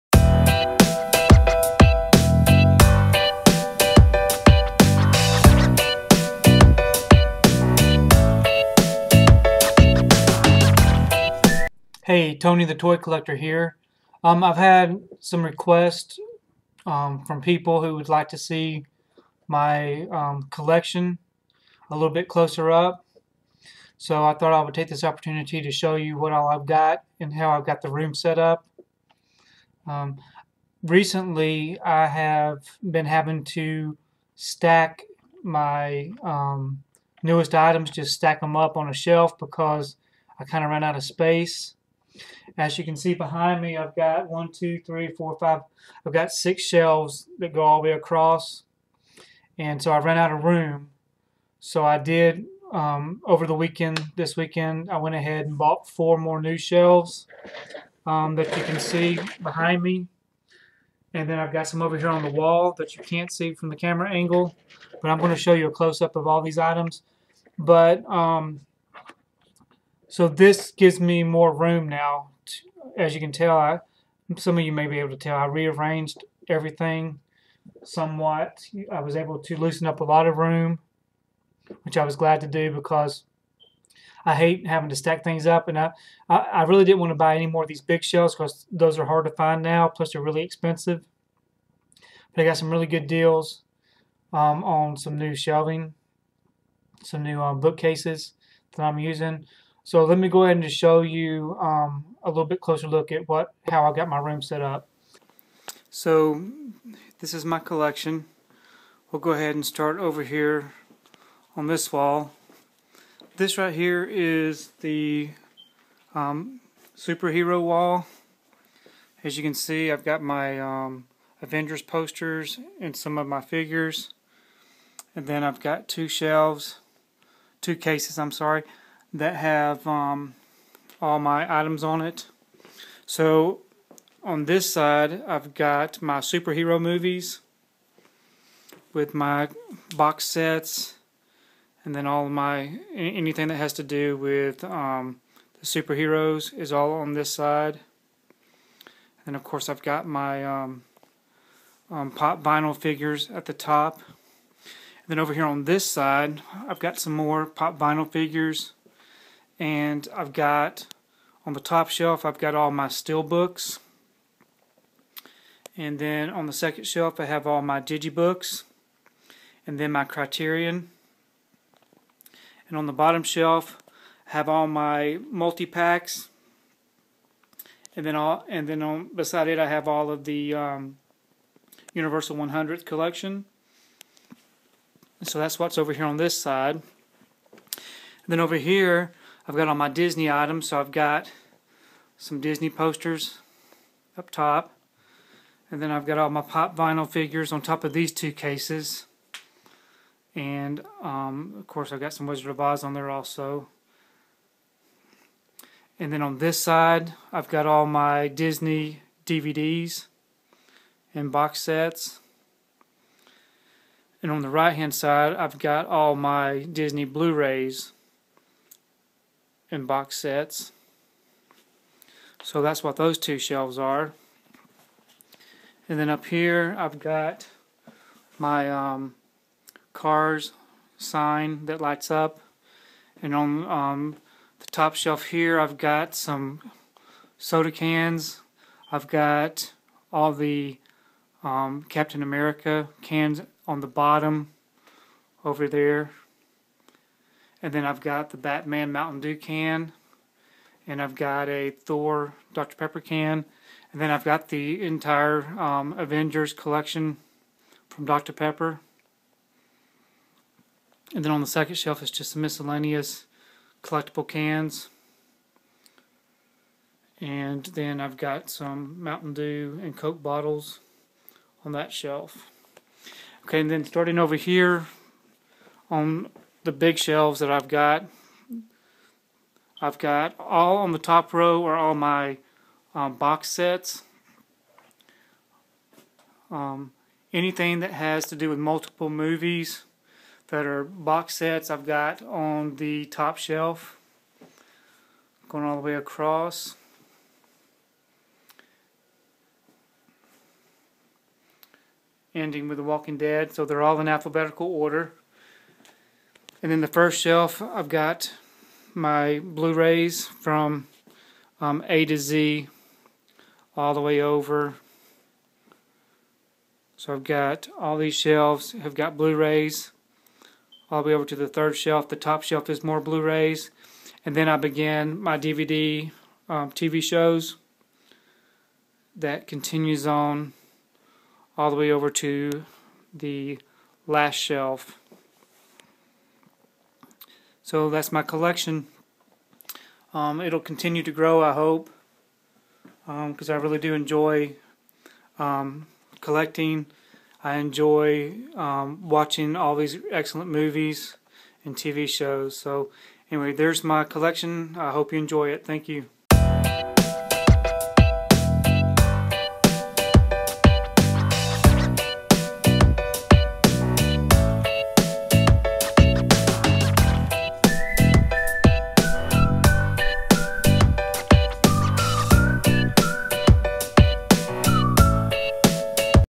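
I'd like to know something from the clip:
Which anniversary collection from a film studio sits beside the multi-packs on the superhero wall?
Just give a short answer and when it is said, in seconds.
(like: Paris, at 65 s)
Universal 100th collection, at 181 s.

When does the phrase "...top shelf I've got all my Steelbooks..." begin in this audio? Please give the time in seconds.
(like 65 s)
161 s.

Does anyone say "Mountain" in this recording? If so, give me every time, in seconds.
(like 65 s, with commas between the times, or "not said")
248 s, 269 s.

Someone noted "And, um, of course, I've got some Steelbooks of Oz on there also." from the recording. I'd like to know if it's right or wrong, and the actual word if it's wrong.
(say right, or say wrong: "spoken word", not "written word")
wrong: "Wizard", not "Steelbooks".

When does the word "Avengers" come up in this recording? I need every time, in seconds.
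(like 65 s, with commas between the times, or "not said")
121 s, 255 s.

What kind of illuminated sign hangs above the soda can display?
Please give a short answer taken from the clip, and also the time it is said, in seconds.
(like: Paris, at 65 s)
Cars sign, at 229 s.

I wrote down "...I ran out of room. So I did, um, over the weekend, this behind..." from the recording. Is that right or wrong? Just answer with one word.
wrong.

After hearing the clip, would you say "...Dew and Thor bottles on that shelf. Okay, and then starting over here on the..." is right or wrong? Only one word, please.
wrong.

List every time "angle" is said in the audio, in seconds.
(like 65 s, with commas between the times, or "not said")
64 s.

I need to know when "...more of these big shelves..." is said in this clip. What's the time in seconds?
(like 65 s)
87 s.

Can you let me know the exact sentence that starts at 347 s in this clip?
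I enjoy um, watching all these excellent movies and TV shows.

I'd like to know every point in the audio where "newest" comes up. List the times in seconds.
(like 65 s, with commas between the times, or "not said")
37 s.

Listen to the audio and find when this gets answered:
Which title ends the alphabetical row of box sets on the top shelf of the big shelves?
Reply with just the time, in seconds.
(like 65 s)
302 s.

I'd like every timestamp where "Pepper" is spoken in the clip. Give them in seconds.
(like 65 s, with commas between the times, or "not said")
252 s, 258 s.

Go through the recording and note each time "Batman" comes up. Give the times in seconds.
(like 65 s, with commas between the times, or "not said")
248 s.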